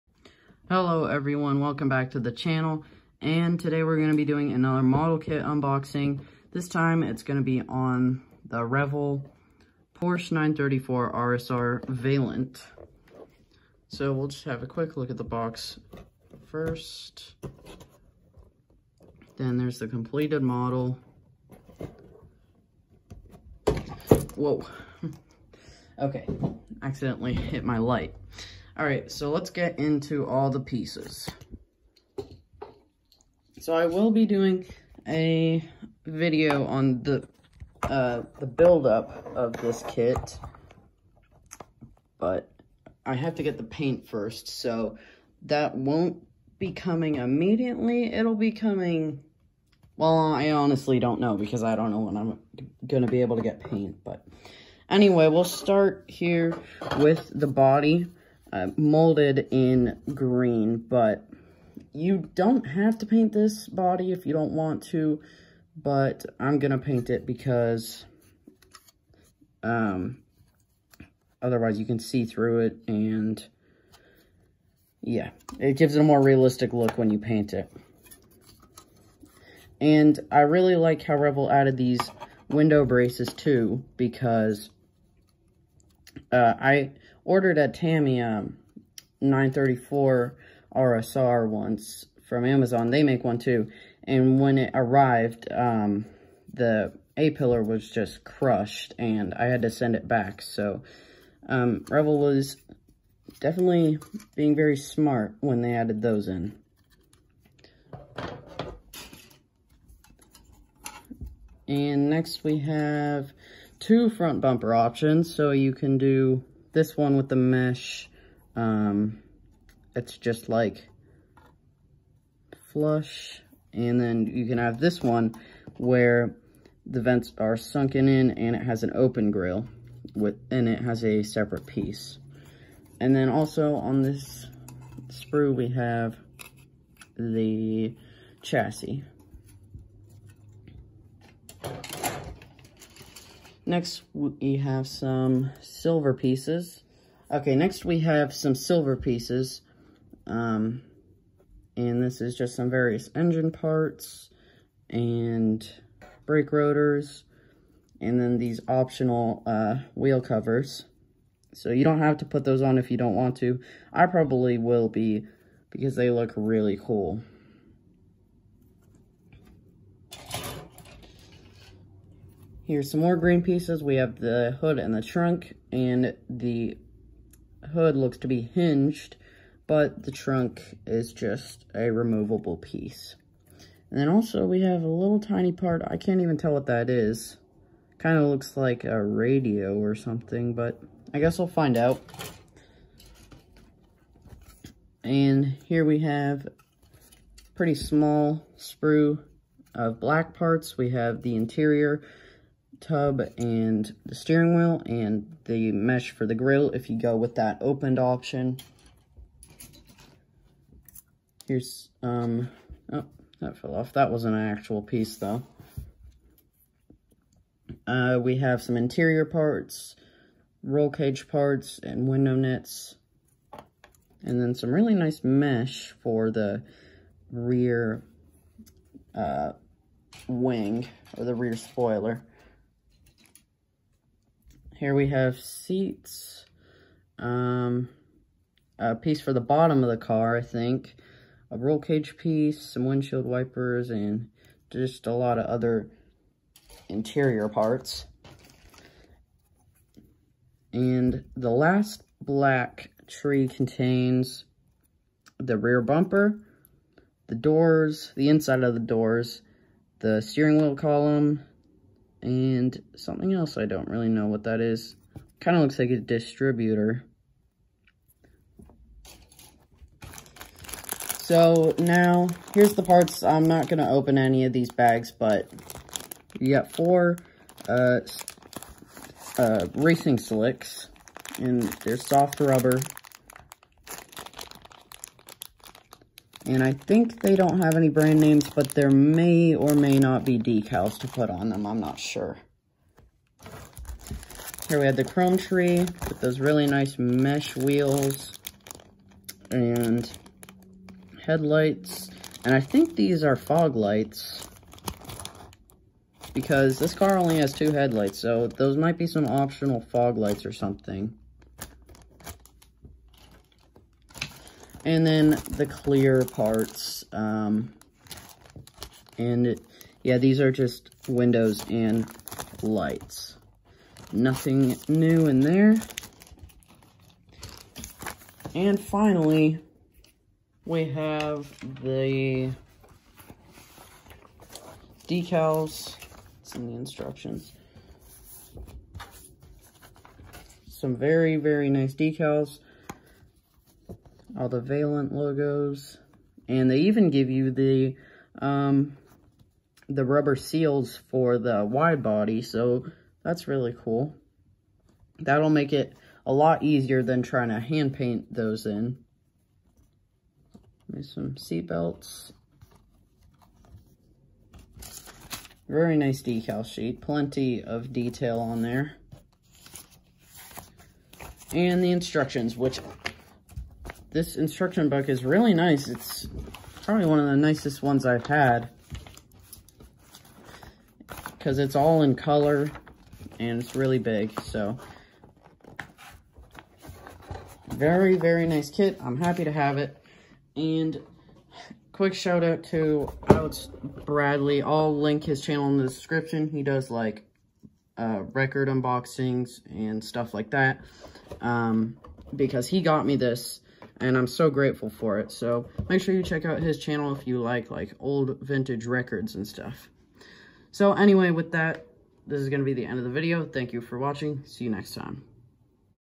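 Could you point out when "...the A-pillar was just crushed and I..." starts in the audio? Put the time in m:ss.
1:36.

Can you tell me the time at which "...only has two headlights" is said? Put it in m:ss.
5:07.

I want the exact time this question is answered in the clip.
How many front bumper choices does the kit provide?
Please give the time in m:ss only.
1:53.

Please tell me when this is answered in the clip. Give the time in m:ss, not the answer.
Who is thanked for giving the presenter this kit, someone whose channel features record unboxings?
6:33.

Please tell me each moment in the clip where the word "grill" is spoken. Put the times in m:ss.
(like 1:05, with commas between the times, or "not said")
2:09, 3:26.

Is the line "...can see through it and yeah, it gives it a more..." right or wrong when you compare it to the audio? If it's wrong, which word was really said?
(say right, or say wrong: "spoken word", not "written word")
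right.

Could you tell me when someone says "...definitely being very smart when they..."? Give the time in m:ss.
1:43.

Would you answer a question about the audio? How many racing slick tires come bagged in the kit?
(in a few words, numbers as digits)
4.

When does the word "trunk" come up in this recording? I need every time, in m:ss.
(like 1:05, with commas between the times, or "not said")
2:55, 3:00.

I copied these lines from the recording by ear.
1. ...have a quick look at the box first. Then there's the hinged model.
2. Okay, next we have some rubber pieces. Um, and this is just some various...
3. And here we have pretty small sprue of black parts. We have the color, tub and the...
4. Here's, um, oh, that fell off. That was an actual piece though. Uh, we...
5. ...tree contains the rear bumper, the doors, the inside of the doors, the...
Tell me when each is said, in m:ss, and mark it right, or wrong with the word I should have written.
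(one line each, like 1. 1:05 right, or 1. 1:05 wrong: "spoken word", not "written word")
1. 0:14 wrong: "completed", not "hinged"
2. 2:27 wrong: "silver", not "rubber"
3. 3:15 wrong: "interior", not "color"
4. 3:31 right
5. 4:13 right.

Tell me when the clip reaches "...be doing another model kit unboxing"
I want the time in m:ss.
0:04.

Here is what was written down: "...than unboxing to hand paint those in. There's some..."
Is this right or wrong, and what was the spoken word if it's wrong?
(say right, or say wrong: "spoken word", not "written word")
wrong: "trying", not "unboxing".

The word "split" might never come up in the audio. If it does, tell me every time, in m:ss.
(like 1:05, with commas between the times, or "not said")
not said.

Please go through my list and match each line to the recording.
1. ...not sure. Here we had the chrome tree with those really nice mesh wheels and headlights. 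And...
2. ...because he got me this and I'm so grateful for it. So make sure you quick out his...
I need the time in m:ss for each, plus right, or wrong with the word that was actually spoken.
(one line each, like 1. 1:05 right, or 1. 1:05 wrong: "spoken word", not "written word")
1. 4:51 right
2. 6:42 wrong: "check", not "quick".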